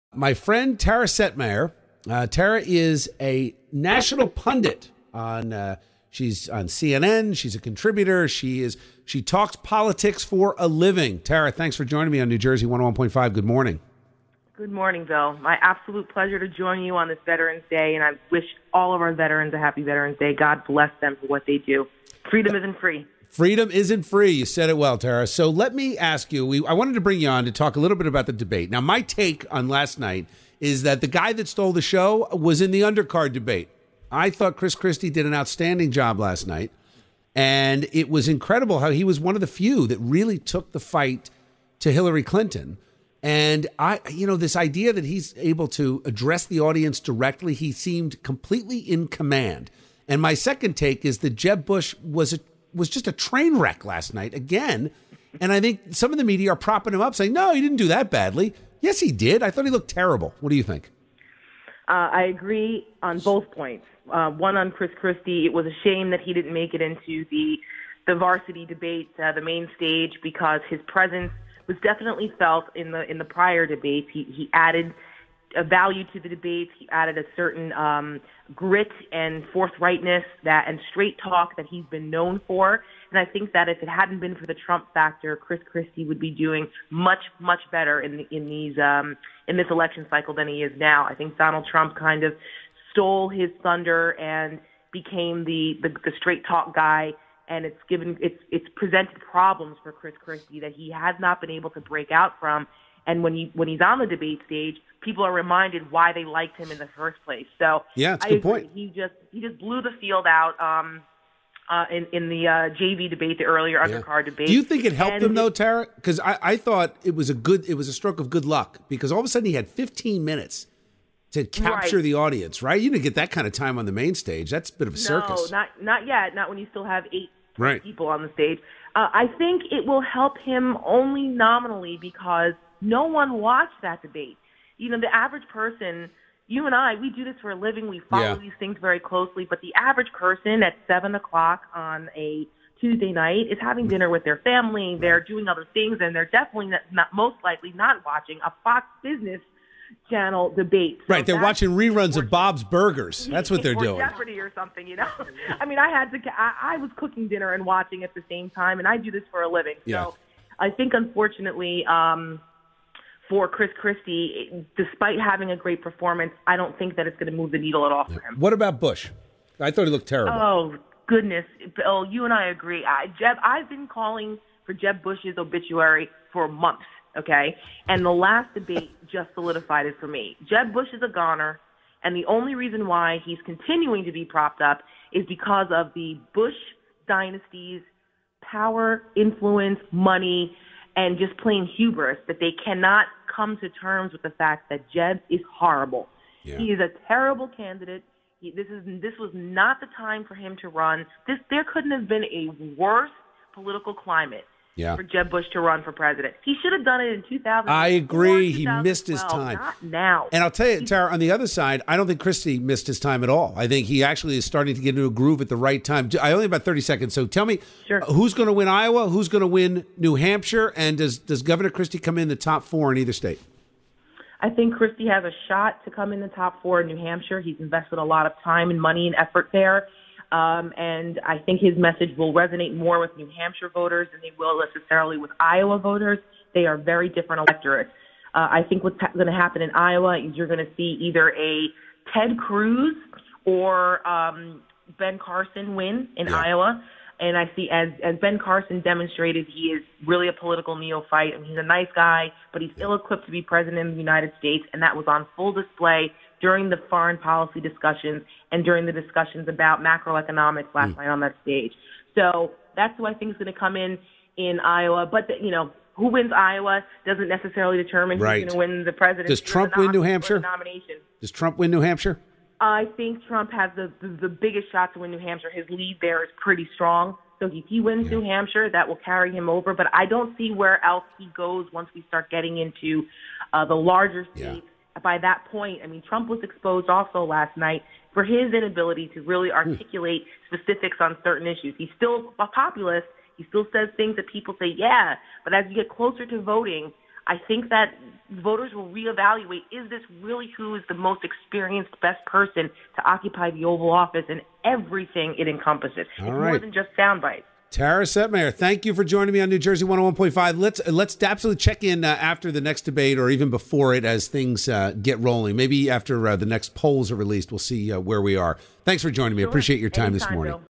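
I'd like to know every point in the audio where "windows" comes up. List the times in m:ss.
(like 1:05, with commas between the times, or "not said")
not said.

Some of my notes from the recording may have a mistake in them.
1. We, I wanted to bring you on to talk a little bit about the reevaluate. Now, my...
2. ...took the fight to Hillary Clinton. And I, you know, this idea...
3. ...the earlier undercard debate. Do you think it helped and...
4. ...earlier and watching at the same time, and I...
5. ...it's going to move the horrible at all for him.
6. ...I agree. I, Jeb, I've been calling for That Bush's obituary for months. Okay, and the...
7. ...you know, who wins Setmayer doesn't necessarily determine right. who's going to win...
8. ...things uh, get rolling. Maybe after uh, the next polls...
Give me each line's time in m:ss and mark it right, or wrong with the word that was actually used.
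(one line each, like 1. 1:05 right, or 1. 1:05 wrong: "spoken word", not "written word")
1. 0:26 wrong: "debate", not "reevaluate"
2. 0:40 right
3. 1:53 right
4. 2:37 wrong: "dinner", not "earlier"
5. 2:47 wrong: "needle", not "horrible"
6. 2:52 wrong: "Jeb", not "That"
7. 4:25 wrong: "Iowa", not "Setmayer"
8. 5:14 right.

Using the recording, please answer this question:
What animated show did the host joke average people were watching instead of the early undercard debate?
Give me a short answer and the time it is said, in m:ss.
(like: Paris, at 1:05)
Bob's Burgers, at 2:32.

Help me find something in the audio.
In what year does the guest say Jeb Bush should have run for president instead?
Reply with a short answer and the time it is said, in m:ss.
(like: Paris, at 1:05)
2000, at 3:27.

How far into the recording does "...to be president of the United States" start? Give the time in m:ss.
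4:13.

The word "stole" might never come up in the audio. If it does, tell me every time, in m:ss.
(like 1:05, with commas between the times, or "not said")
0:31, 1:32.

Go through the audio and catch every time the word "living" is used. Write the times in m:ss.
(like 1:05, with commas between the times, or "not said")
0:10, 2:17, 2:39.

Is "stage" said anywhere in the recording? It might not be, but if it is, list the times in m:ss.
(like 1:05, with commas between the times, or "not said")
1:09, 1:44, 2:04, 2:08, 4:21.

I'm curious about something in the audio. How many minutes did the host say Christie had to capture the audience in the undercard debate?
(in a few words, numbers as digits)
15.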